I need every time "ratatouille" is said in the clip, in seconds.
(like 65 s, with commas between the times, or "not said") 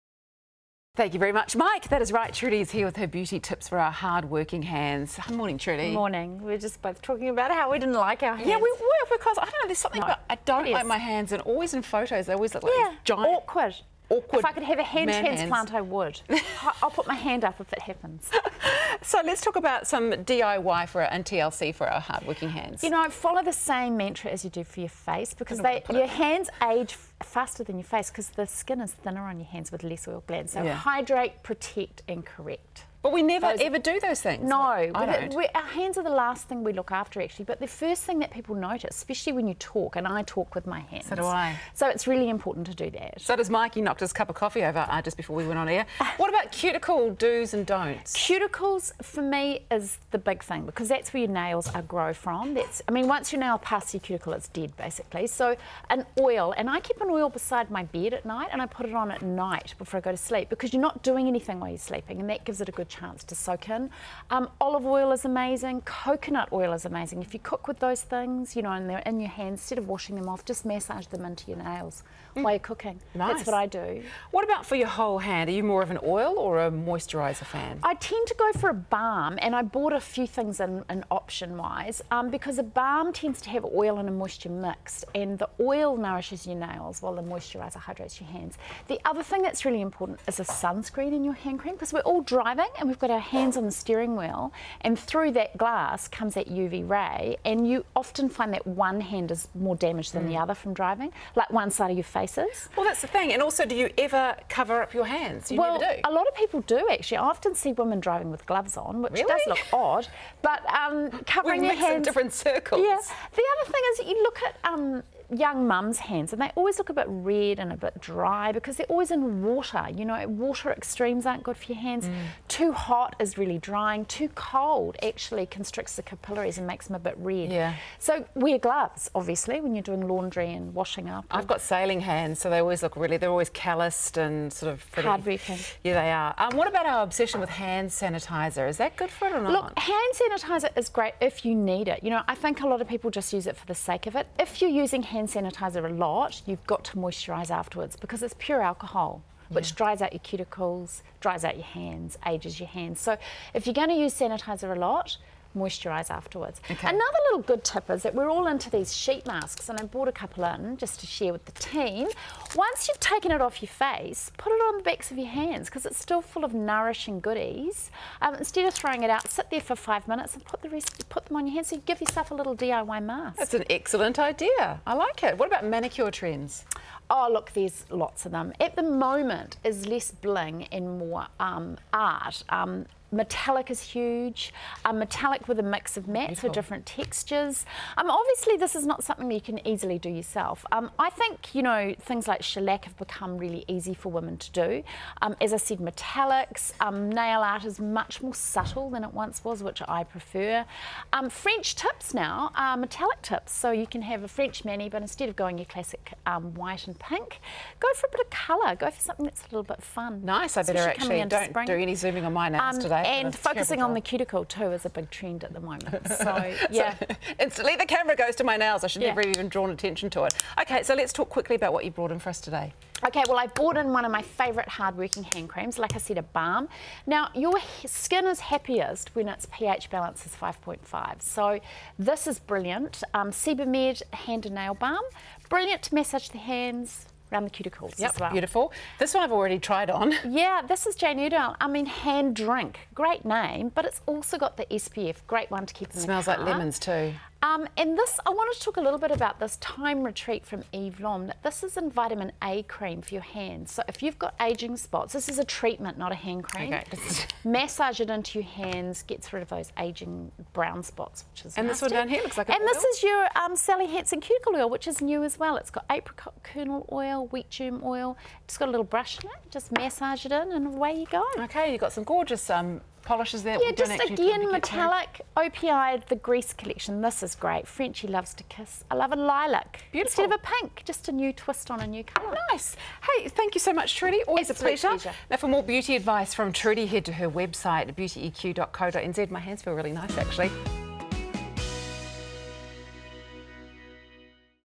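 not said.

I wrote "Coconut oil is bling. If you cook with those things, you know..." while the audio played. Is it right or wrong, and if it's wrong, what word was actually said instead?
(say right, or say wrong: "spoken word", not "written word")
wrong: "amazing", not "bling".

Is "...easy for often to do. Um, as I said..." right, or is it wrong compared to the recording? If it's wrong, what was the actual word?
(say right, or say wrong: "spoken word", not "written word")
wrong: "women", not "often".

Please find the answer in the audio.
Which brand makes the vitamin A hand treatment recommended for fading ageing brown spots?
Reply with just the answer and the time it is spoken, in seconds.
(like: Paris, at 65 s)
Eve Lom, at 250 s.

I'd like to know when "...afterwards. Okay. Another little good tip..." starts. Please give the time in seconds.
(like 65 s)
156 s.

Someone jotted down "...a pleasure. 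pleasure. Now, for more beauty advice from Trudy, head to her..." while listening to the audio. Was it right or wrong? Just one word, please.
right.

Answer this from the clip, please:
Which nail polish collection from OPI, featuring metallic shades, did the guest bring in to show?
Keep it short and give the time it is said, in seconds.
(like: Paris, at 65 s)
the Grease collection, at 276 s.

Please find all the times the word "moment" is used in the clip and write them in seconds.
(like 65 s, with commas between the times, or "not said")
178 s, 215 s.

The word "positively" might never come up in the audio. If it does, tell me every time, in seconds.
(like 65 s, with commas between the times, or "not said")
not said.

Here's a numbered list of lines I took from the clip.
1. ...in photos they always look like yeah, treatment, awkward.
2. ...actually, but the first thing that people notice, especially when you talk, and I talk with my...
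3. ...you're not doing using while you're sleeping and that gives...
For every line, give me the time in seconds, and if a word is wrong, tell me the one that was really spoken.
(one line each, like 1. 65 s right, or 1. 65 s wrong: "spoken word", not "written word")
1. 11 s wrong: "giant", not "treatment"
2. 37 s right
3. 60 s wrong: "anything", not "using".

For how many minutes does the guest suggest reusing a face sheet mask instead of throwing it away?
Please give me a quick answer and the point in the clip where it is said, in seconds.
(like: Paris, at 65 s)
5 minutes, at 169 s.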